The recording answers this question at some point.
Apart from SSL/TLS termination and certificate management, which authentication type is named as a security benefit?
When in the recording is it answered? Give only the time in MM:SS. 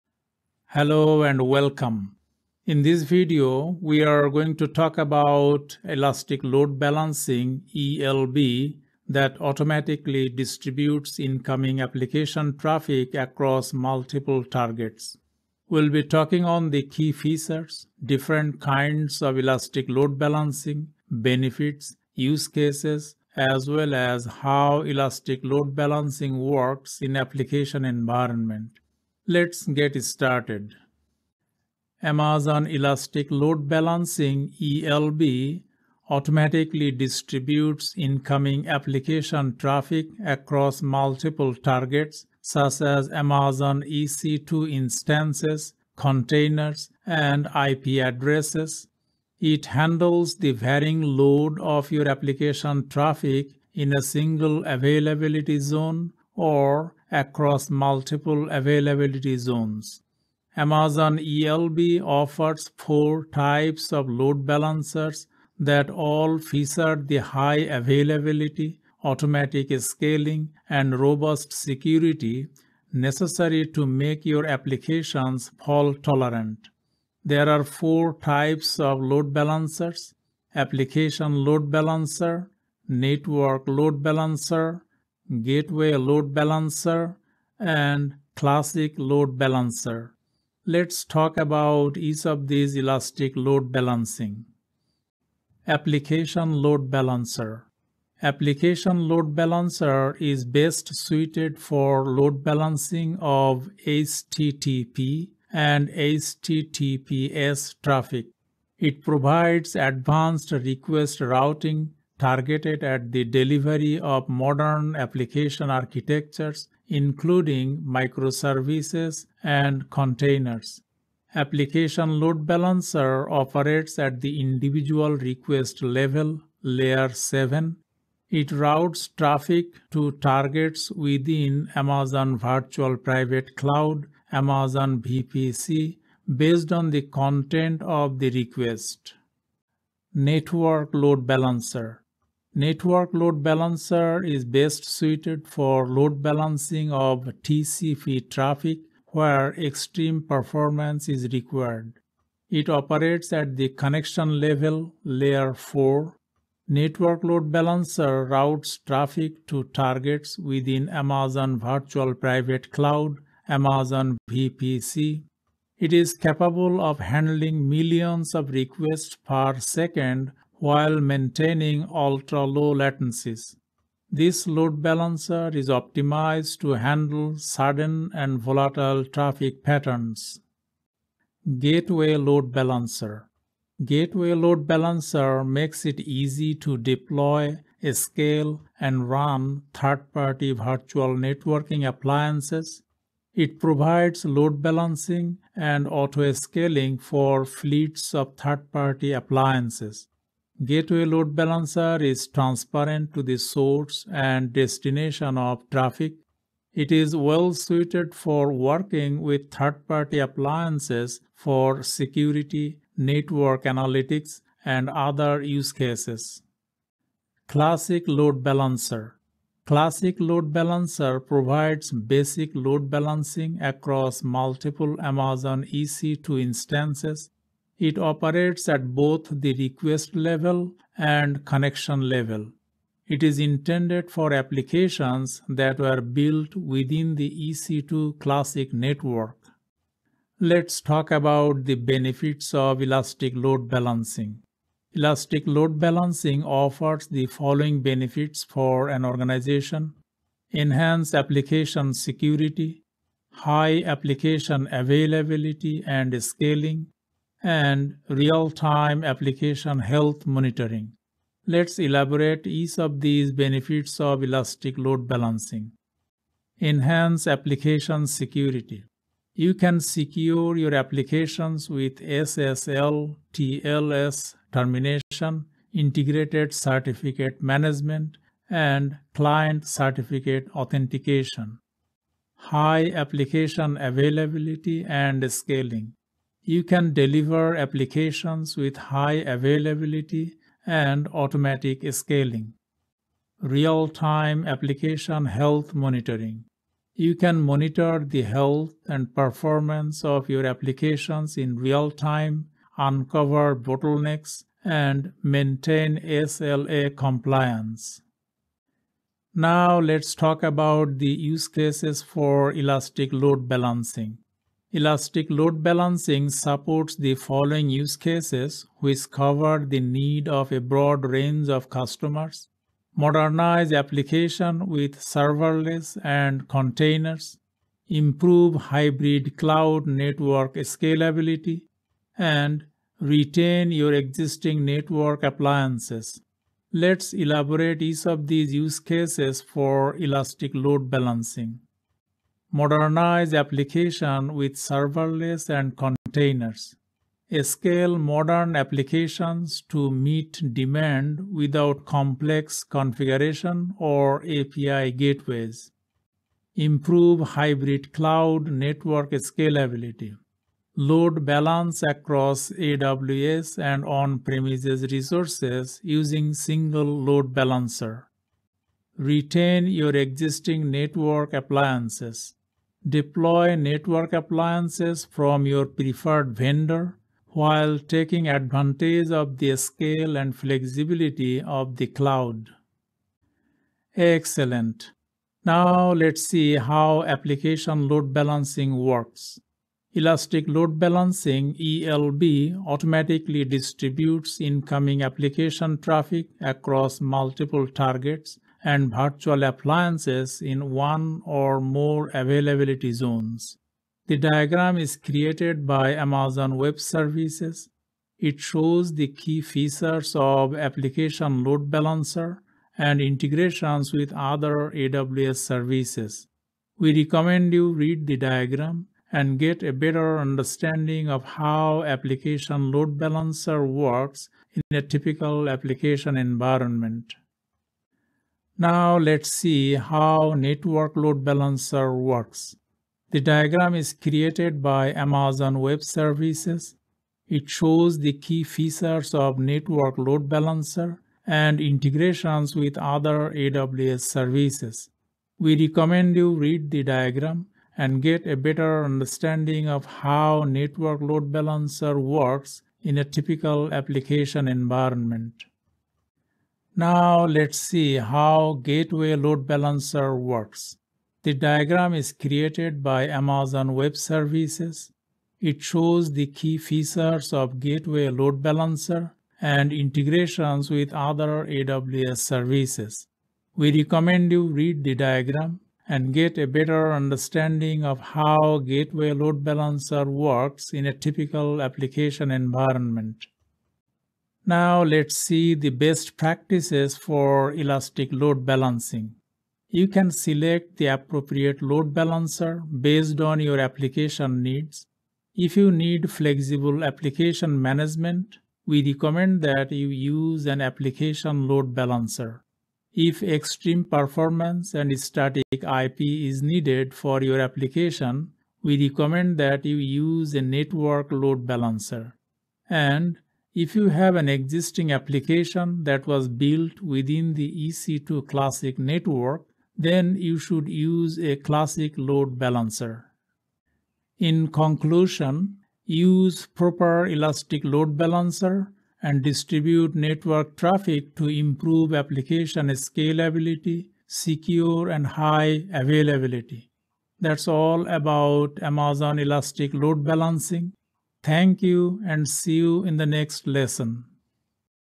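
04:39.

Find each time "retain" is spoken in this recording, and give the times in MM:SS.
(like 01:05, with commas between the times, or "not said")
05:33, 06:08.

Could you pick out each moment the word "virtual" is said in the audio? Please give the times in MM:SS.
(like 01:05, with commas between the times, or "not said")
02:12, 02:41, 03:10, 06:38.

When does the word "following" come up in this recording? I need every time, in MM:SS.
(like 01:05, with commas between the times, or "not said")
04:07, 05:17.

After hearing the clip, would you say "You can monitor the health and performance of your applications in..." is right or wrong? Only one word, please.
right.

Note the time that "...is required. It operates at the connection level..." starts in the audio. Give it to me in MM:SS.
02:31.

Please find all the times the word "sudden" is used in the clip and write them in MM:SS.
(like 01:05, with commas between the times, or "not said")
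02:57.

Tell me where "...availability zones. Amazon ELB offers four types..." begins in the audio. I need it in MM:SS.
00:58.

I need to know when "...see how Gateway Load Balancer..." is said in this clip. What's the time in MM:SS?
07:37.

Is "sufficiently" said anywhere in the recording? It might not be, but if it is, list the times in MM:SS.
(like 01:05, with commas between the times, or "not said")
not said.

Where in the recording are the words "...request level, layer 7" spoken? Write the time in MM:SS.
02:05.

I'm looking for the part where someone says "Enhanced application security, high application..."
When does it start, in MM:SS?
04:10.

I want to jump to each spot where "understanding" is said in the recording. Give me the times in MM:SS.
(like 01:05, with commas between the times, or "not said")
07:00, 07:28, 07:56.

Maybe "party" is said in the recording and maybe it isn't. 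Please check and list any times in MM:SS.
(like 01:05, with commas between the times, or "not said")
03:09, 03:18, 03:29.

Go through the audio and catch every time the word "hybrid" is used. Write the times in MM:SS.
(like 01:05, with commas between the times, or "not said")
05:28, 05:57.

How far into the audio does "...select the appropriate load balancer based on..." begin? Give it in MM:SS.
08:10.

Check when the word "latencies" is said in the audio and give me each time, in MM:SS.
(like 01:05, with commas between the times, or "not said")
02:52.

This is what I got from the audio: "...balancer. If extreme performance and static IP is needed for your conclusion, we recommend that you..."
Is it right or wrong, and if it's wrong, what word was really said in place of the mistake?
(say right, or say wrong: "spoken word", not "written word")
wrong: "application", not "conclusion".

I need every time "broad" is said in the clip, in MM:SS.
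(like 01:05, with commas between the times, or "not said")
05:20.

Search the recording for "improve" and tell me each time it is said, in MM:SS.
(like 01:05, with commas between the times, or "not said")
05:27, 05:56, 08:51.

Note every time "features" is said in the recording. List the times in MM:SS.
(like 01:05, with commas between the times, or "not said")
00:17, 01:06, 06:49, 07:18, 07:46.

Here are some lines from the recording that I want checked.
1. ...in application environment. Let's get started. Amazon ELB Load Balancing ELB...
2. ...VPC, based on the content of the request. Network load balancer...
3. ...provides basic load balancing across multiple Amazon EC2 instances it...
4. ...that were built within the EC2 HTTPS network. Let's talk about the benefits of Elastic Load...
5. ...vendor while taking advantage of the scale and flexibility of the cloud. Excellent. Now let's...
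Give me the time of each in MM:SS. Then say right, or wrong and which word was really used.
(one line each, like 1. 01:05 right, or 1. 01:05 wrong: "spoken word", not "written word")
1. 00:27 wrong: "Elastic", not "ELB"
2. 02:15 right
3. 03:41 right
4. 03:55 wrong: "Classic", not "HTTPS"
5. 06:16 right.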